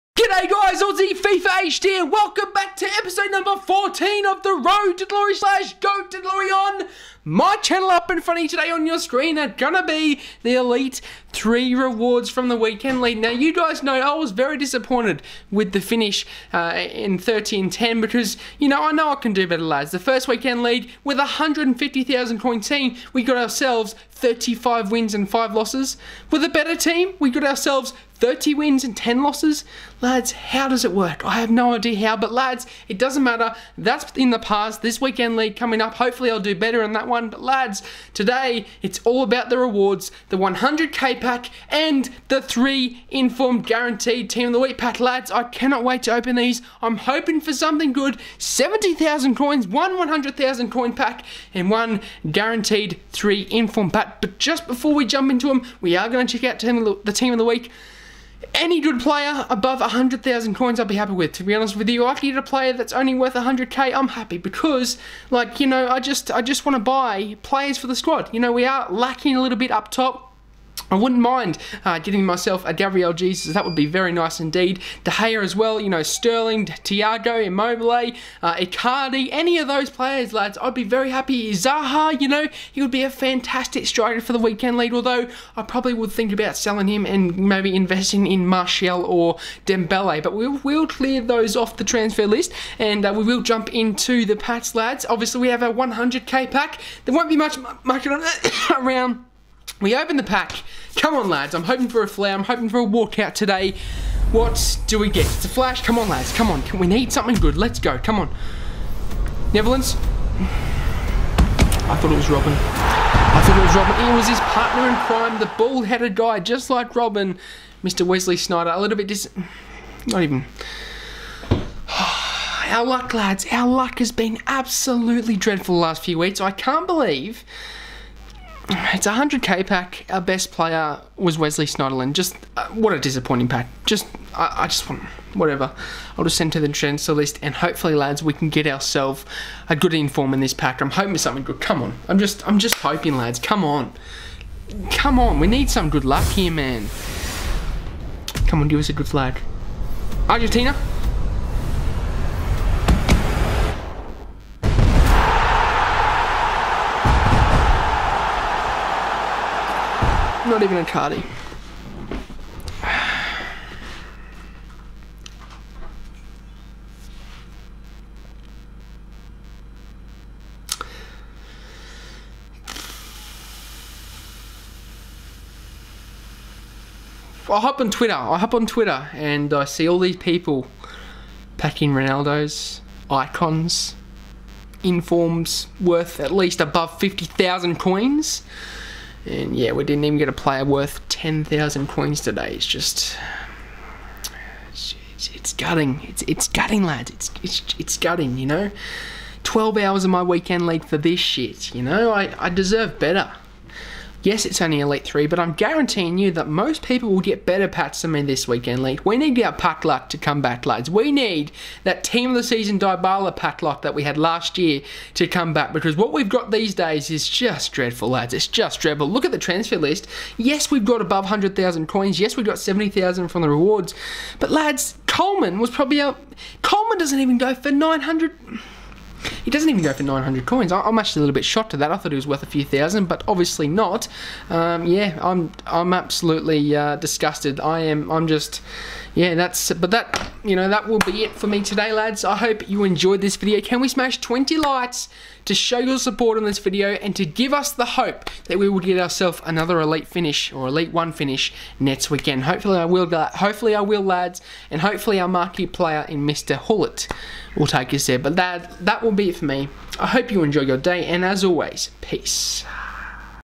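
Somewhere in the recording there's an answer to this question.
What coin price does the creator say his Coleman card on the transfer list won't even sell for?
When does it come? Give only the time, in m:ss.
3:50.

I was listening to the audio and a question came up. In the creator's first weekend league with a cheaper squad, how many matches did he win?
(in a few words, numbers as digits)
35.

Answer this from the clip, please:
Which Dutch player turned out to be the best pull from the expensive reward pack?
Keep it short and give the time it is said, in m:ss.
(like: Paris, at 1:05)
Wesley Sneijder, at 1:57.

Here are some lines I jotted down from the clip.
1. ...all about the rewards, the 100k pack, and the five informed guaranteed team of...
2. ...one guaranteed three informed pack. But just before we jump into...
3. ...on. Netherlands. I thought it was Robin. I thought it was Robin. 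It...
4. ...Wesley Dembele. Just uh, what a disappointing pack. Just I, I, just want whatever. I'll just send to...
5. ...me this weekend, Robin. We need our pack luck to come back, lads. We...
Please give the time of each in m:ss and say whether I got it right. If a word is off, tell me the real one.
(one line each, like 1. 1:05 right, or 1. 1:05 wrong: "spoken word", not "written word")
1. 0:39 wrong: "three", not "five"
2. 0:51 right
3. 1:48 right
4. 2:11 wrong: "Snyderlin", not "Dembele"
5. 3:28 wrong: "Lee", not "Robin".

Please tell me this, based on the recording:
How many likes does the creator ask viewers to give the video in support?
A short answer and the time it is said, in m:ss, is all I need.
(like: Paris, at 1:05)
20, at 4:04.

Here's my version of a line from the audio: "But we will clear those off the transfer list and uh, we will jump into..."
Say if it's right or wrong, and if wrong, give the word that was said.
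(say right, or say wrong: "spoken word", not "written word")
right.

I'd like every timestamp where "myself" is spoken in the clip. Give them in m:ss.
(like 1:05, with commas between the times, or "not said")
1:12.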